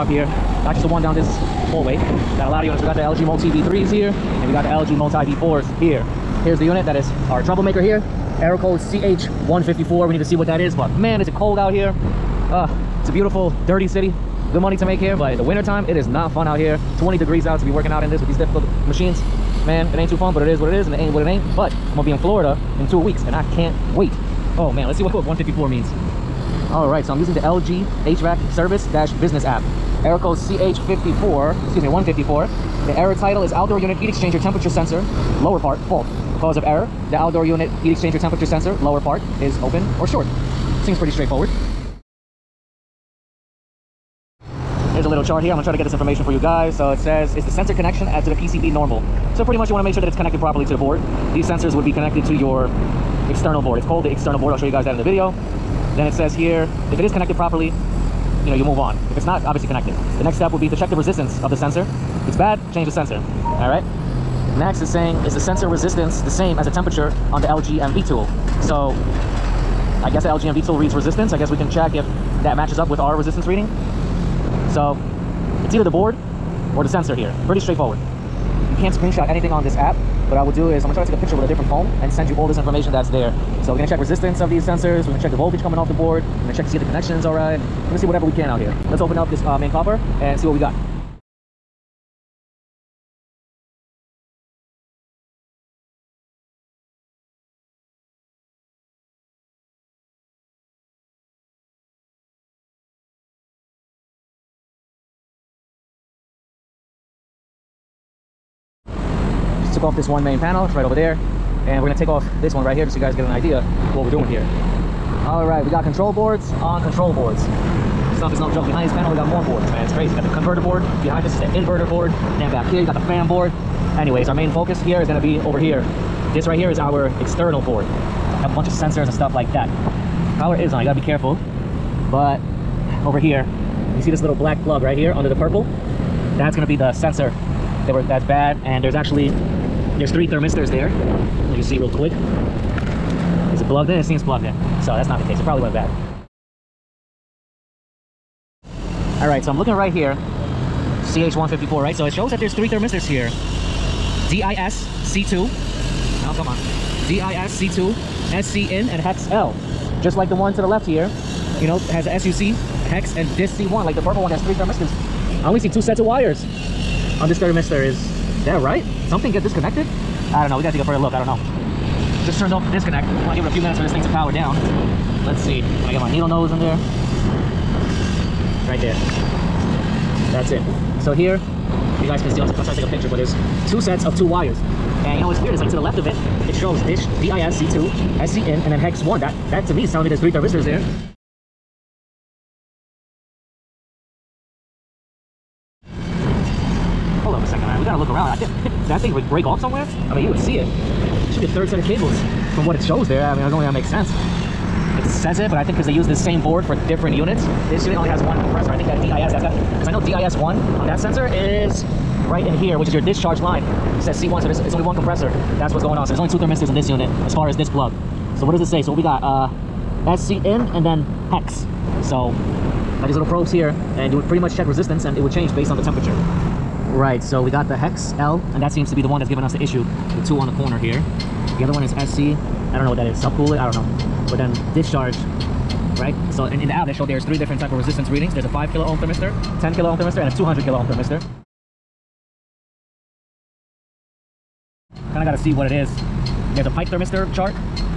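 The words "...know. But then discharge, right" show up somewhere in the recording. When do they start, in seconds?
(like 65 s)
233 s.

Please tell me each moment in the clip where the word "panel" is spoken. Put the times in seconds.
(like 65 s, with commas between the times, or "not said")
110 s, 118 s.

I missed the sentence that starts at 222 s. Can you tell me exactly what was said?
So got these little probes here and you would pretty much check resistance and it would change based on the temperature.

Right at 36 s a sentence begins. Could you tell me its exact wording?
Cause of error, the outdoor unit heat exchanger temperature sensor, lower part, is open or short.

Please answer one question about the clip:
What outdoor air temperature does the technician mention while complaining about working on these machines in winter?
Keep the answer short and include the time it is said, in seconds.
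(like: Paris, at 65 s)
20 degrees, at 17 s.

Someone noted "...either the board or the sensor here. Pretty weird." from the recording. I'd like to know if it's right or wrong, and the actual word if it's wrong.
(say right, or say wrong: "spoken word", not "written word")
wrong: "straightforward", not "weird".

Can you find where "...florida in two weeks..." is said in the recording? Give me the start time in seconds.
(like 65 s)
22 s.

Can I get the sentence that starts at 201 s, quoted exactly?
should be a third set of cables from what it shows there.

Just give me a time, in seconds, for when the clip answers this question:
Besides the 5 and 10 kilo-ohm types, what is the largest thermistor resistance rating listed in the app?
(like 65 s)
240 s.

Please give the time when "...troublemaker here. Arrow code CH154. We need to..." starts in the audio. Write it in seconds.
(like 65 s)
7 s.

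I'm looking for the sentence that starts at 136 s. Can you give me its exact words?
That's gonna be the sensor that were that's bad.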